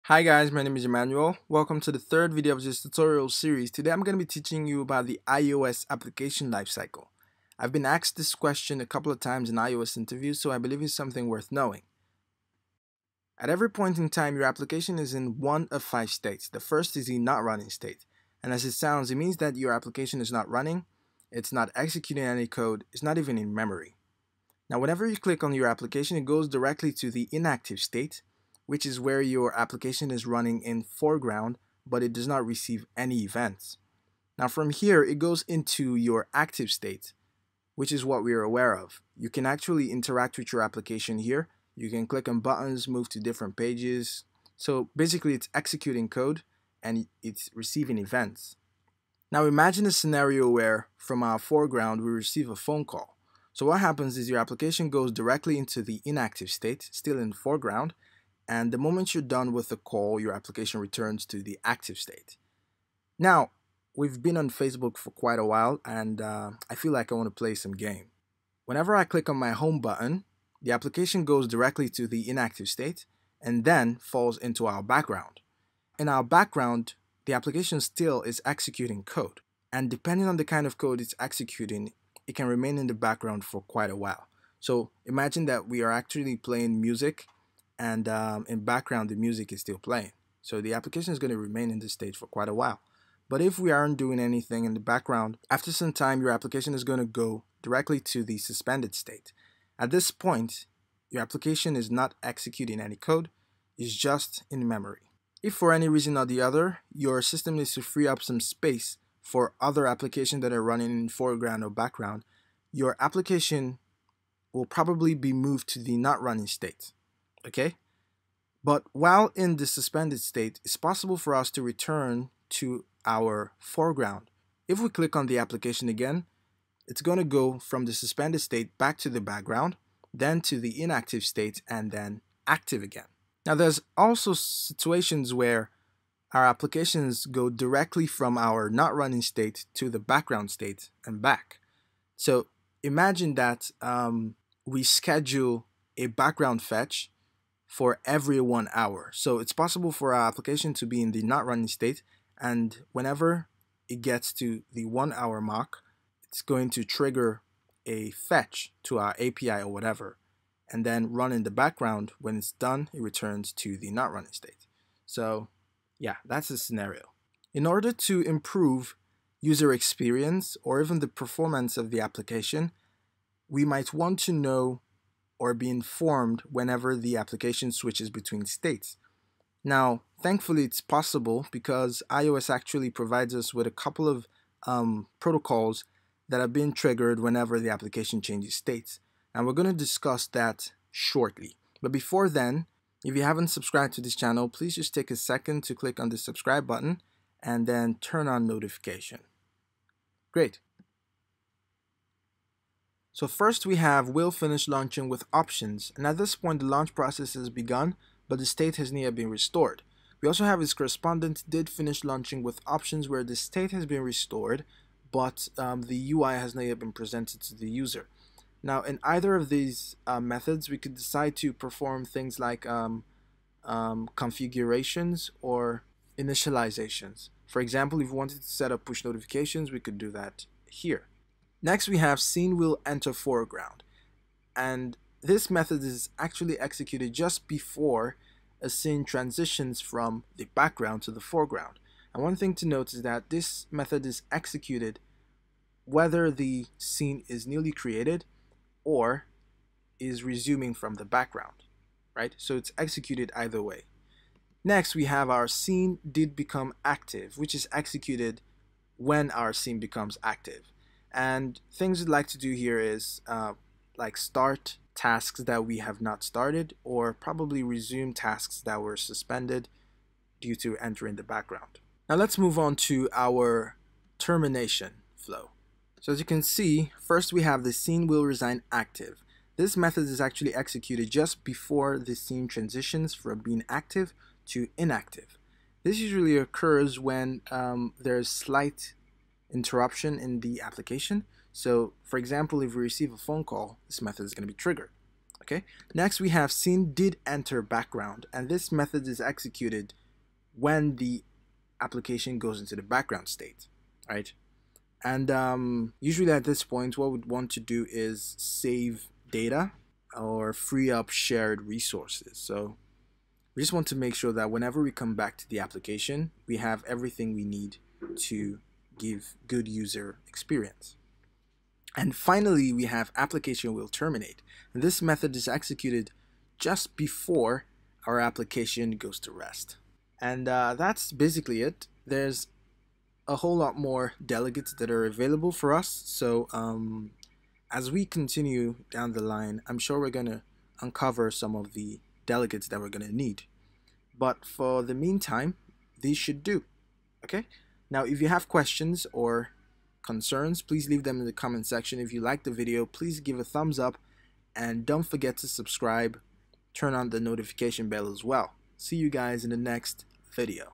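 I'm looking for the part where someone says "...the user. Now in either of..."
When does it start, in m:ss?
3:37.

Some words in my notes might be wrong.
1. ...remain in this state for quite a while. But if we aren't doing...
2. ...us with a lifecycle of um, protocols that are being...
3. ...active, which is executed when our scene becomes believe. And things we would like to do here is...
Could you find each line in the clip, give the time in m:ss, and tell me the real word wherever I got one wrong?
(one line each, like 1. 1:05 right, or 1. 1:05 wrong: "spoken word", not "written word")
1. 1:31 right
2. 3:03 wrong: "couple", not "lifecycle"
3. 4:16 wrong: "active", not "believe".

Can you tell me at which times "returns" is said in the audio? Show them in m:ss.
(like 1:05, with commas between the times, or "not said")
1:00, 2:01, 2:43.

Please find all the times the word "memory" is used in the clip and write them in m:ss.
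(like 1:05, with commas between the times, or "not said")
0:23, 1:44.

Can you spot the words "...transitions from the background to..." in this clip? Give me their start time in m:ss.
3:59.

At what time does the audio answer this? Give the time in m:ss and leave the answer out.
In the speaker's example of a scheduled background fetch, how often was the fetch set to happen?
2:28.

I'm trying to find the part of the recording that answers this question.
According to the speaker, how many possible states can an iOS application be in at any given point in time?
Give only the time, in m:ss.
0:15.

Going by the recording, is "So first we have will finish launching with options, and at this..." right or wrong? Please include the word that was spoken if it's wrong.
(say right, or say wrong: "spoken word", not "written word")
right.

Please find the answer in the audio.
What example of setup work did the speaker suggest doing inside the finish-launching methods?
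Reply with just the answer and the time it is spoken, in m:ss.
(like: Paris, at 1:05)
Push notifications, at 3:48.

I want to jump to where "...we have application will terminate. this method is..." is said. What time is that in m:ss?
5:22.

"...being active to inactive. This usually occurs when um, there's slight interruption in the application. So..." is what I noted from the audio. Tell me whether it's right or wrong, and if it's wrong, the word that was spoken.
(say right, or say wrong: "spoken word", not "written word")
right.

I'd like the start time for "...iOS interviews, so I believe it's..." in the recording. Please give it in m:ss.
0:09.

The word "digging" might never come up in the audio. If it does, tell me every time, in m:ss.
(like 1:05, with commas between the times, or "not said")
not said.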